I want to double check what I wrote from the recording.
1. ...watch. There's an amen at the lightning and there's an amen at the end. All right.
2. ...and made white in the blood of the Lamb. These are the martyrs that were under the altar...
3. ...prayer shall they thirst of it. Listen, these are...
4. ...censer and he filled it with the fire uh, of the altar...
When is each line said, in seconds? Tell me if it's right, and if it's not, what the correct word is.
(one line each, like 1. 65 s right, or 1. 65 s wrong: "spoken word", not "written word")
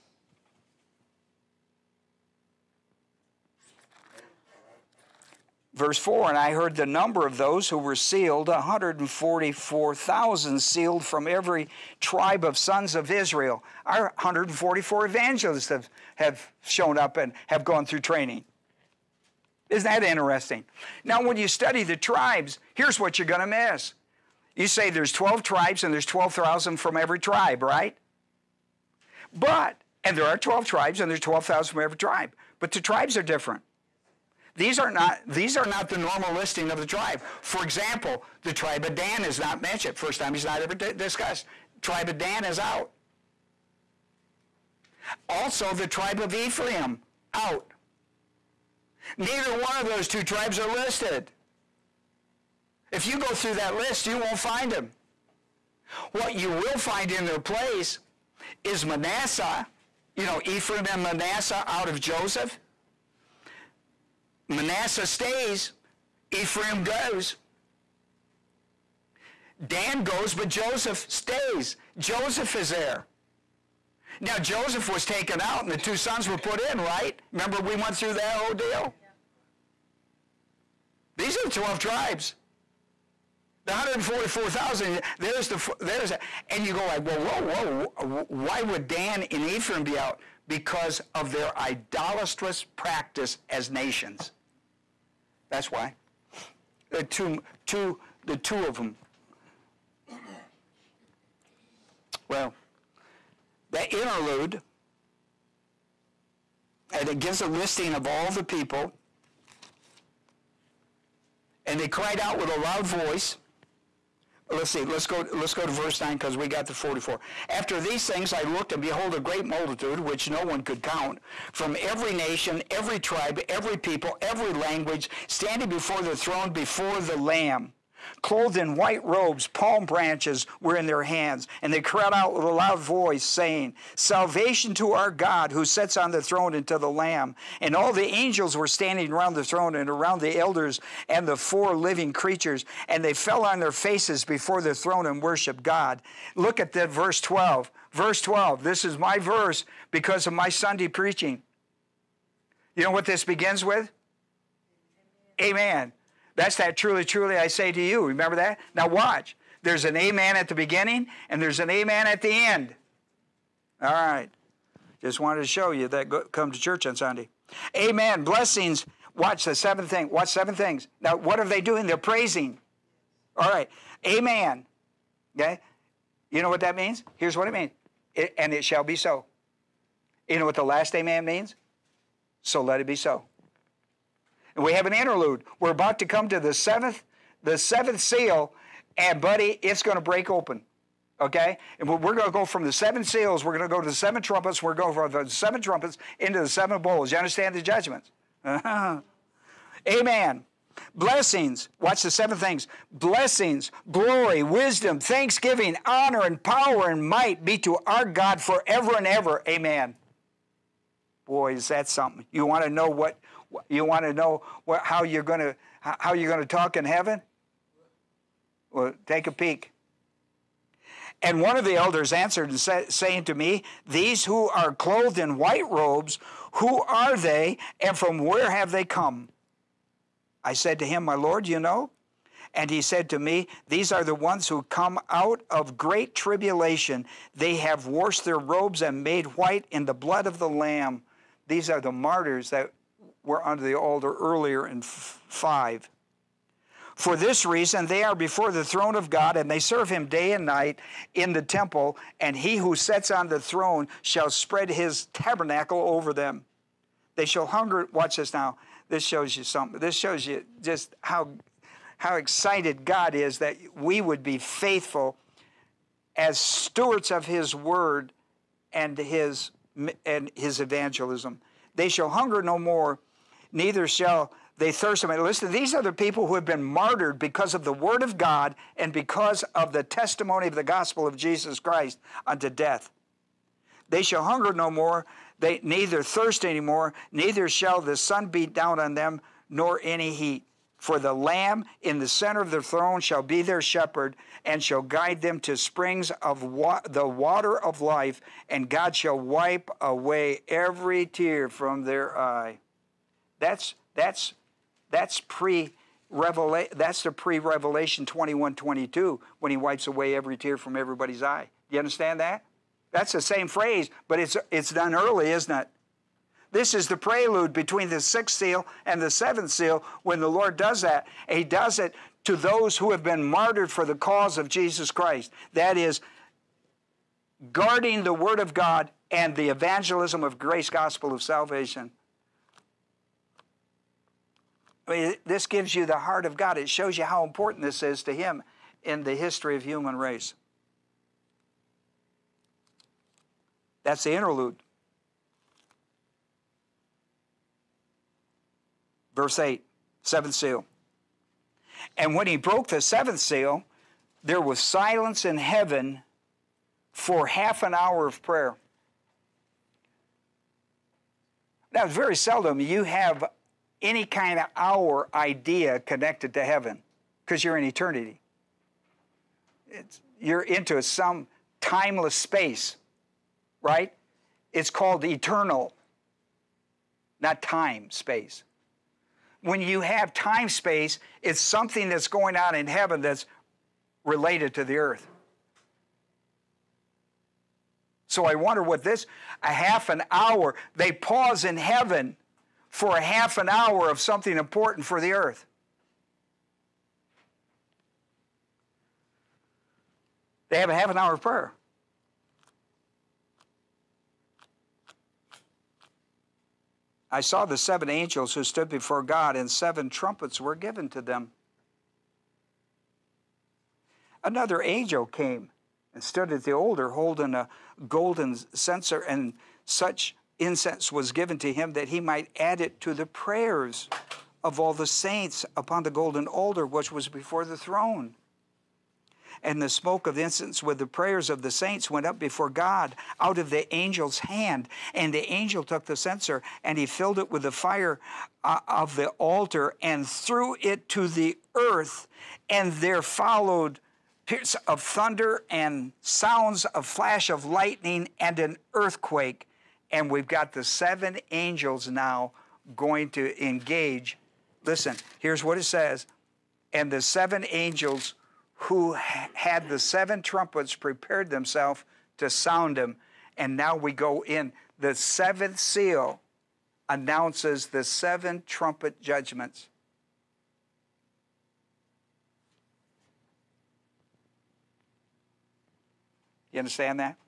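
1. 158 s wrong: "beginning", not "lightning"
2. 238 s right
3. 273 s wrong: "neither", not "prayer"
4. 435 s right.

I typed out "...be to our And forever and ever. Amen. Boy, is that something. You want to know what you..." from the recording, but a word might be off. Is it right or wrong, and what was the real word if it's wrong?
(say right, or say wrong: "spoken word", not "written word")
wrong: "God", not "And".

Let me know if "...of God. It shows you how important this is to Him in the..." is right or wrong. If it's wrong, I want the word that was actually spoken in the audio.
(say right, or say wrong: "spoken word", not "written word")
right.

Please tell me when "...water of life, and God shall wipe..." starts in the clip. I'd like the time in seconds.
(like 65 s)
297 s.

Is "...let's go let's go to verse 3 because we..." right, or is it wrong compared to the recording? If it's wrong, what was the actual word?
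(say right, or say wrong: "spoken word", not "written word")
wrong: "9", not "3".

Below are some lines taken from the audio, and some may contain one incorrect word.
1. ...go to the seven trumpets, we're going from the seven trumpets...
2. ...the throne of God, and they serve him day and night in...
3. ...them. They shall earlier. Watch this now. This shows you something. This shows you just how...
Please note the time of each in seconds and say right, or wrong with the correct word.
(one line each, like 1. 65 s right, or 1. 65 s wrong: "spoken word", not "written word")
1. 193 s right
2. 248 s right
3. 256 s wrong: "hunger", not "earlier".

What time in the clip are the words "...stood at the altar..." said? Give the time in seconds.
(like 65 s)
416 s.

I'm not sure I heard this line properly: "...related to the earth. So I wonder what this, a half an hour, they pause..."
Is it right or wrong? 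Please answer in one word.
right.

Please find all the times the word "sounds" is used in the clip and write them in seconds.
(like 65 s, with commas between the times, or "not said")
446 s, 462 s.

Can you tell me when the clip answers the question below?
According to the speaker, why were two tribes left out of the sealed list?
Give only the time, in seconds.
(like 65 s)
91 s.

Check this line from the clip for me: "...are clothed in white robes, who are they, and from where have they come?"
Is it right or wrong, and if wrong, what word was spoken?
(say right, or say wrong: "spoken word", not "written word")
right.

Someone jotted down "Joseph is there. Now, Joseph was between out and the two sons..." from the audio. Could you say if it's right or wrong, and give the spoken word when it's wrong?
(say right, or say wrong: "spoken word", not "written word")
wrong: "taken", not "between".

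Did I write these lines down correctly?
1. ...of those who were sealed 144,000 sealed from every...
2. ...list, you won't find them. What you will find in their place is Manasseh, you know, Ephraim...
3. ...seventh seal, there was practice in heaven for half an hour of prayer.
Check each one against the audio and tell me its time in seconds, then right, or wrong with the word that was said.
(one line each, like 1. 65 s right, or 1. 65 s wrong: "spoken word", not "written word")
1. 7 s right
2. 53 s right
3. 352 s wrong: "silence", not "practice".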